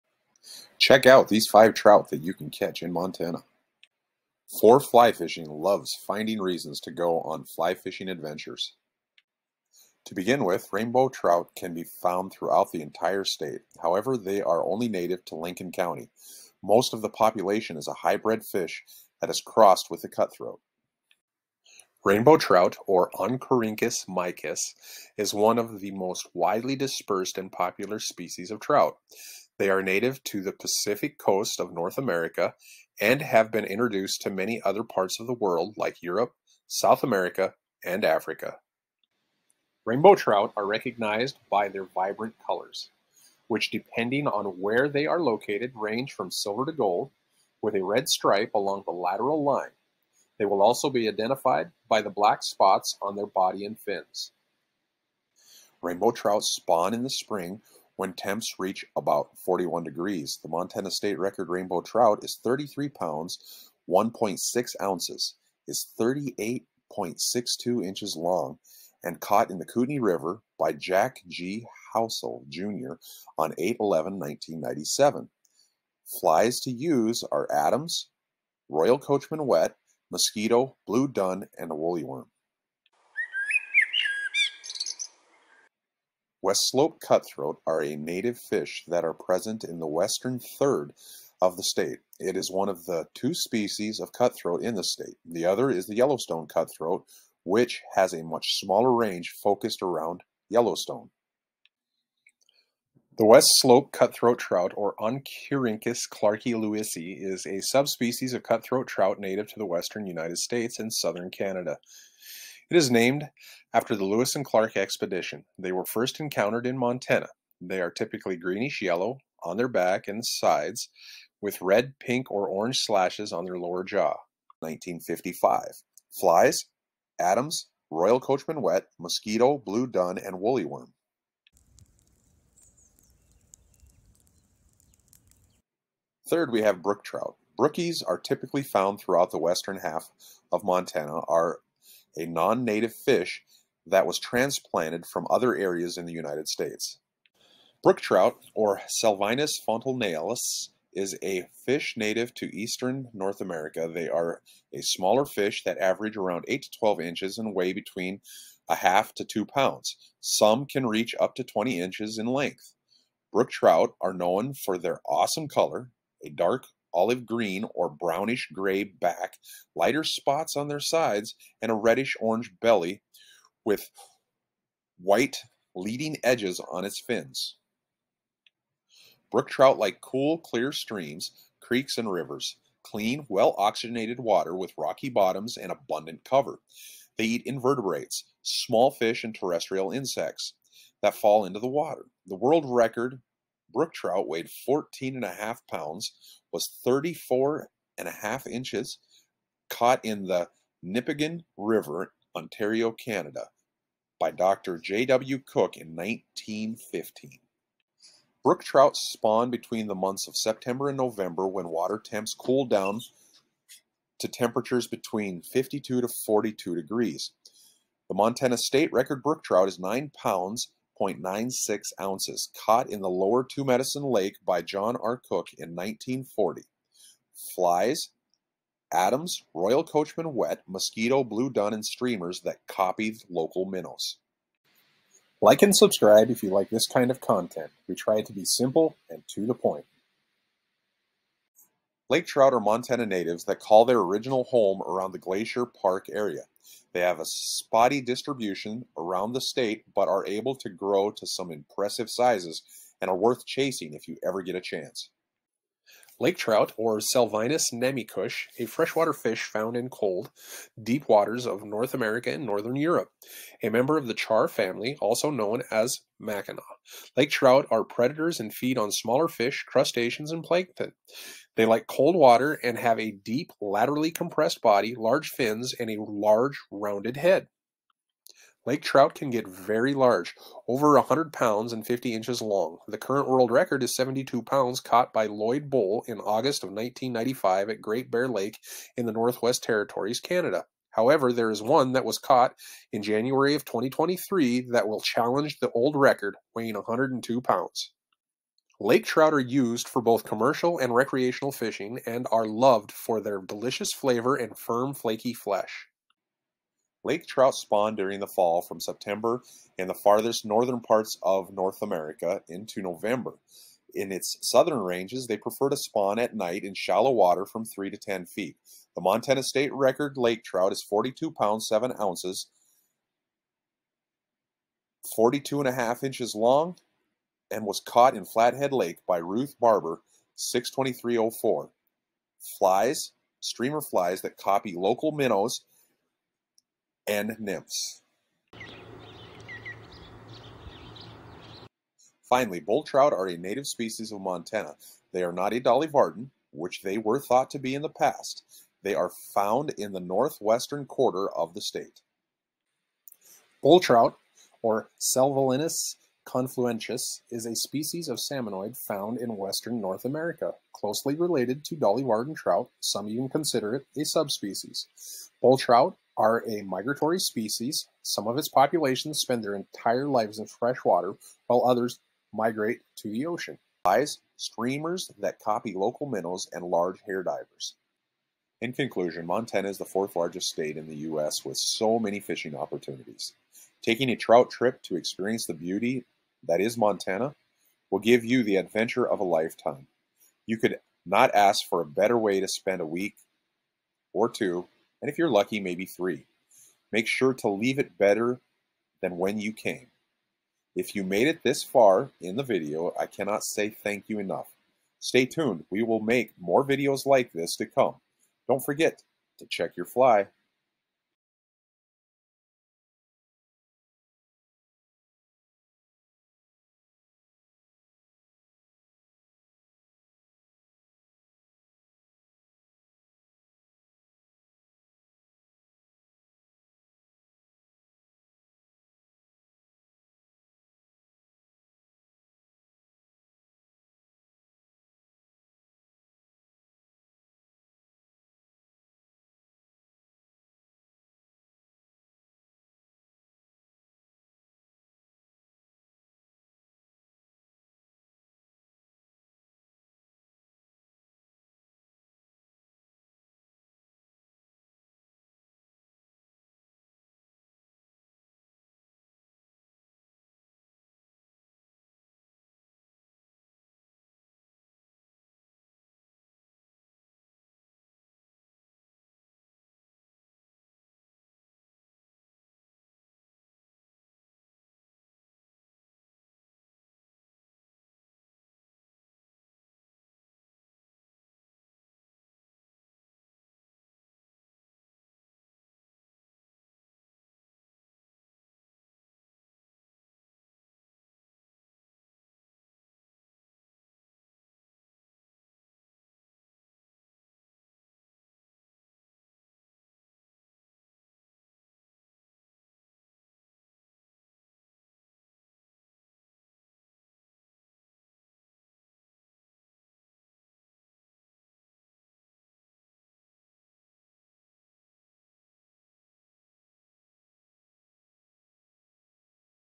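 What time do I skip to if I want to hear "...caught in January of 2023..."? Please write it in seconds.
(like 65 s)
292 s.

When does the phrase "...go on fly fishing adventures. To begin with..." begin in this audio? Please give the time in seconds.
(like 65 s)
6 s.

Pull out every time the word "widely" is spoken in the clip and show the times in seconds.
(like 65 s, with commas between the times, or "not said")
26 s.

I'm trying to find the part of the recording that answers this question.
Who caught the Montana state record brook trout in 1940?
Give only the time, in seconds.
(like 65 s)
224 s.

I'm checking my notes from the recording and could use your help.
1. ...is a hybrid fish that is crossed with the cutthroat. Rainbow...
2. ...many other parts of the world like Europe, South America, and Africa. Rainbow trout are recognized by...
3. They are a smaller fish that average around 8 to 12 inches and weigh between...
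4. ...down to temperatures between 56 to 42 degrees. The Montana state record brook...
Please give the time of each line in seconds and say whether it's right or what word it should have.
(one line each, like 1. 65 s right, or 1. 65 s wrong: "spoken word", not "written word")
1. 17 s right
2. 34 s right
3. 153 s right
4. 212 s wrong: "52", not "56".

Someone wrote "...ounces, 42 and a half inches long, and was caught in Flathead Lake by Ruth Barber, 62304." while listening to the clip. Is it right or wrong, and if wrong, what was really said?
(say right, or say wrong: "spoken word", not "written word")
right.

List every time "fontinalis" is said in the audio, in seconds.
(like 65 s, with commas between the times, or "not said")
149 s.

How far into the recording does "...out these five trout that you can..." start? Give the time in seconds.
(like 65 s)
1 s.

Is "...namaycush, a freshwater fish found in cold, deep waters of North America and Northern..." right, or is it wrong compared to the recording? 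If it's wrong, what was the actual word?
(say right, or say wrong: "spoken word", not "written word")
right.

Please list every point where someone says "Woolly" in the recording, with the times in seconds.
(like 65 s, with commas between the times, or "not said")
81 s, 130 s.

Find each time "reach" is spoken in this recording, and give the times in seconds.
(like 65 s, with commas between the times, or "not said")
58 s, 160 s.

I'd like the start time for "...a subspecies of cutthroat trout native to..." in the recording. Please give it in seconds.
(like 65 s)
107 s.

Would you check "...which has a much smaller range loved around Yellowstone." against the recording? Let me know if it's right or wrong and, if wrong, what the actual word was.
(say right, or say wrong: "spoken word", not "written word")
wrong: "focused", not "loved".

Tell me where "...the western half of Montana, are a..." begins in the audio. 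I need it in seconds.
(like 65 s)
139 s.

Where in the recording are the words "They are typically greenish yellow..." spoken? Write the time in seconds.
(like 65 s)
117 s.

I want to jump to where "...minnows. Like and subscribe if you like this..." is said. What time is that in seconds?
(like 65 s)
233 s.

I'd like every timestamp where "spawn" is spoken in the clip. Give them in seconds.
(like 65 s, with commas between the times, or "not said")
56 s, 208 s, 307 s, 315 s.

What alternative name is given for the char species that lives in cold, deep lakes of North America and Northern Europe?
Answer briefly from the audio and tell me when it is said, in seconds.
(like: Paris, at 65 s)
mackinaw, at 266 s.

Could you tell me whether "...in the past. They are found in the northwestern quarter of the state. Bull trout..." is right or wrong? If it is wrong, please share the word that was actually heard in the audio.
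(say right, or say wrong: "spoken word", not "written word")
right.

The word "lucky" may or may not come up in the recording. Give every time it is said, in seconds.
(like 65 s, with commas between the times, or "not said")
395 s.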